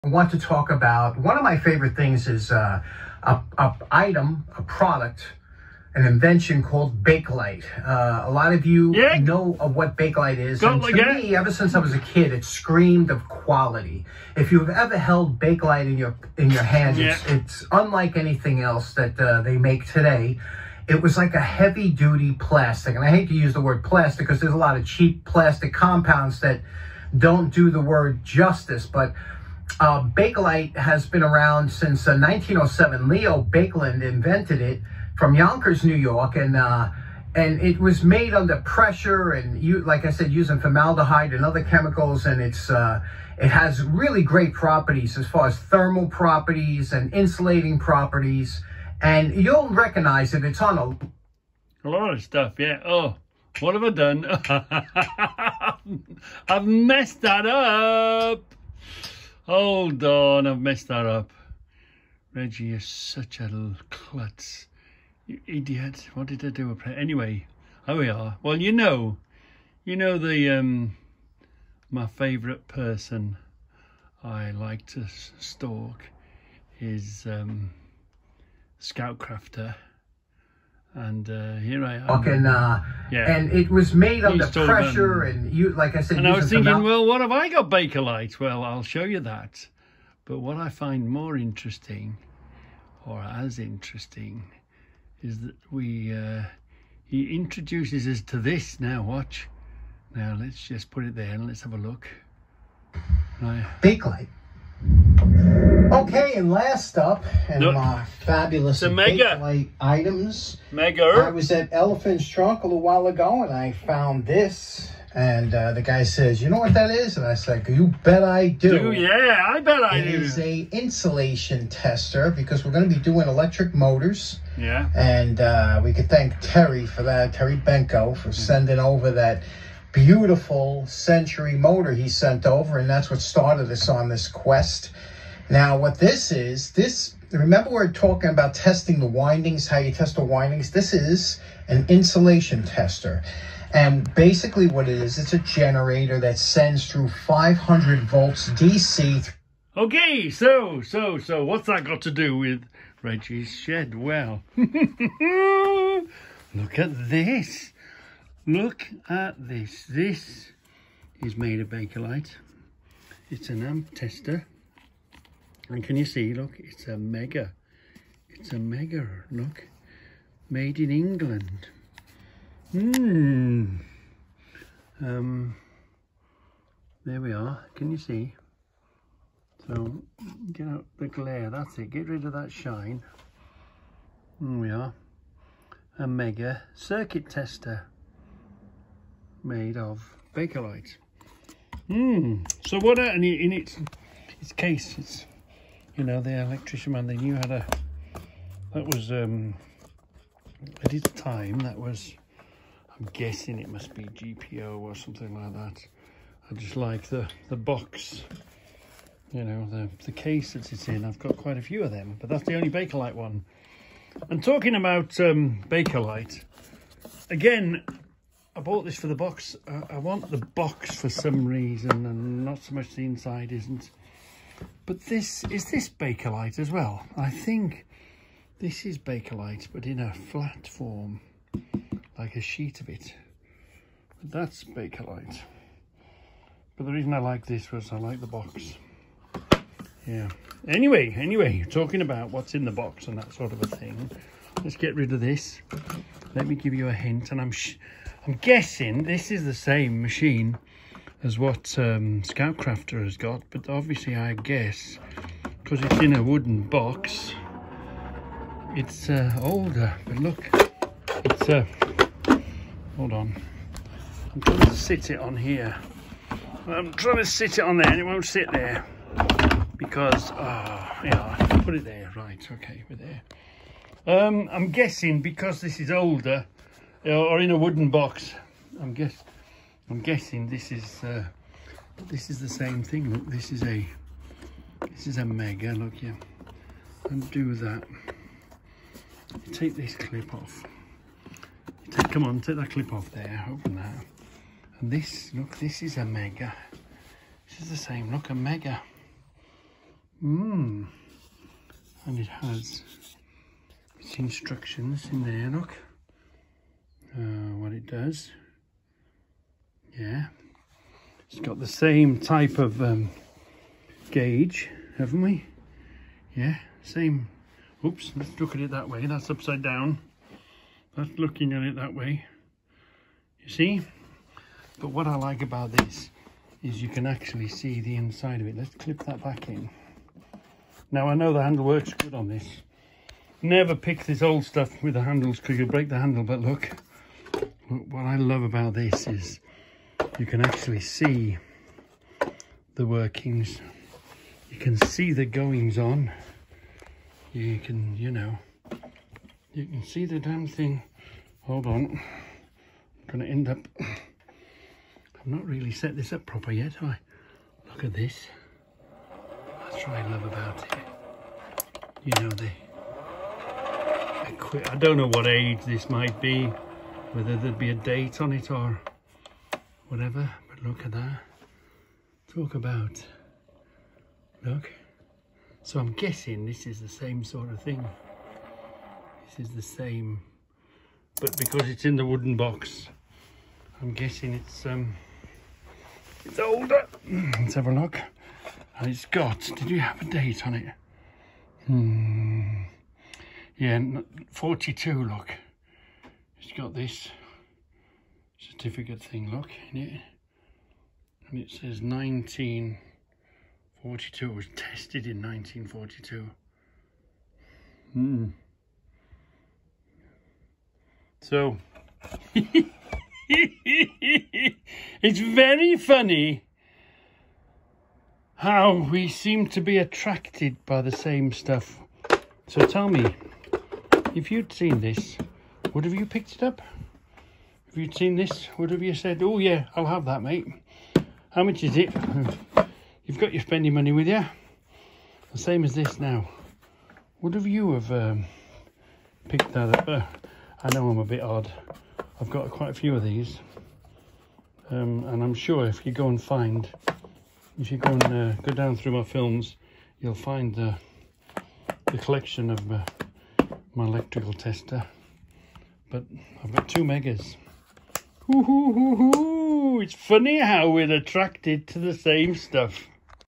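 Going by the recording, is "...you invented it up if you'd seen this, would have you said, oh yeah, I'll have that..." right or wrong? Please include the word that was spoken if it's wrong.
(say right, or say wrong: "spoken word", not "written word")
wrong: "picked", not "invented".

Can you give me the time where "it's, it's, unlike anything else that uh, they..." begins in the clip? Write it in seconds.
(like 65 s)
17 s.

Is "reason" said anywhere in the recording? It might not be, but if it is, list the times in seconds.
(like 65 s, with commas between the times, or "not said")
221 s, 236 s.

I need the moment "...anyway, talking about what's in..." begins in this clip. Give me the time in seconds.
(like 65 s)
241 s.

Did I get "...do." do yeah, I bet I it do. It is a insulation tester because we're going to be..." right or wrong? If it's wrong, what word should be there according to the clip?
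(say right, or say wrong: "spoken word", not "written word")
right.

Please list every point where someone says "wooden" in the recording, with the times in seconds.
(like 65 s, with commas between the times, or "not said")
256 s, 277 s, 382 s.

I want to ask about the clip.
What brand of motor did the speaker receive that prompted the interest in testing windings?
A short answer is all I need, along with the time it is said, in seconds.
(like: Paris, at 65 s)
Century, at 130 s.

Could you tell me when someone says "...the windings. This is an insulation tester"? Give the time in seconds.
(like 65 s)
140 s.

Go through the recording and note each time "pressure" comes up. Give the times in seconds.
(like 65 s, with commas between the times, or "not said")
38 s, 84 s.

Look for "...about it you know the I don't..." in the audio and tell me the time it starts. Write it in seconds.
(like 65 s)
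360 s.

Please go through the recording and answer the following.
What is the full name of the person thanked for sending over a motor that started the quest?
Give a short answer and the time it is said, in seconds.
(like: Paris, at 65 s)
Terry Benko, at 127 s.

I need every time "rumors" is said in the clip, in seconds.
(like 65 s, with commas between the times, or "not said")
not said.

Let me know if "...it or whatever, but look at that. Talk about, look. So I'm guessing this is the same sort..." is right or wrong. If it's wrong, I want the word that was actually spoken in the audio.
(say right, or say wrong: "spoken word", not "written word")
right.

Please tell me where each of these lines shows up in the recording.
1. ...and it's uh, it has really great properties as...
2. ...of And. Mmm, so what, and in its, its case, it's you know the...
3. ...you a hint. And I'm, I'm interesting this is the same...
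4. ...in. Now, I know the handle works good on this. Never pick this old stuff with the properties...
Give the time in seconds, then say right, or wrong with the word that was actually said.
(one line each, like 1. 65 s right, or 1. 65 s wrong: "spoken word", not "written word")
1. 42 s right
2. 189 s wrong: "Bakelite", not "And"
3. 246 s wrong: "guessing", not "interesting"
4. 329 s wrong: "handles", not "properties".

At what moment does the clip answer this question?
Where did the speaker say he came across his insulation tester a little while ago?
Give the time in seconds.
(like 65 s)
111 s.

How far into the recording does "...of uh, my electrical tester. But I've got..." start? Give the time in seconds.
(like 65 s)
452 s.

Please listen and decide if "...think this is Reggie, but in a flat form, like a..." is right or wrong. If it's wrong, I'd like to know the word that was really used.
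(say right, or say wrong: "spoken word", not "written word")
wrong: "Bakelite", not "Reggie".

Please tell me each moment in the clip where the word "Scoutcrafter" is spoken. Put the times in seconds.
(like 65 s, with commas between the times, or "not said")
78 s, 252 s.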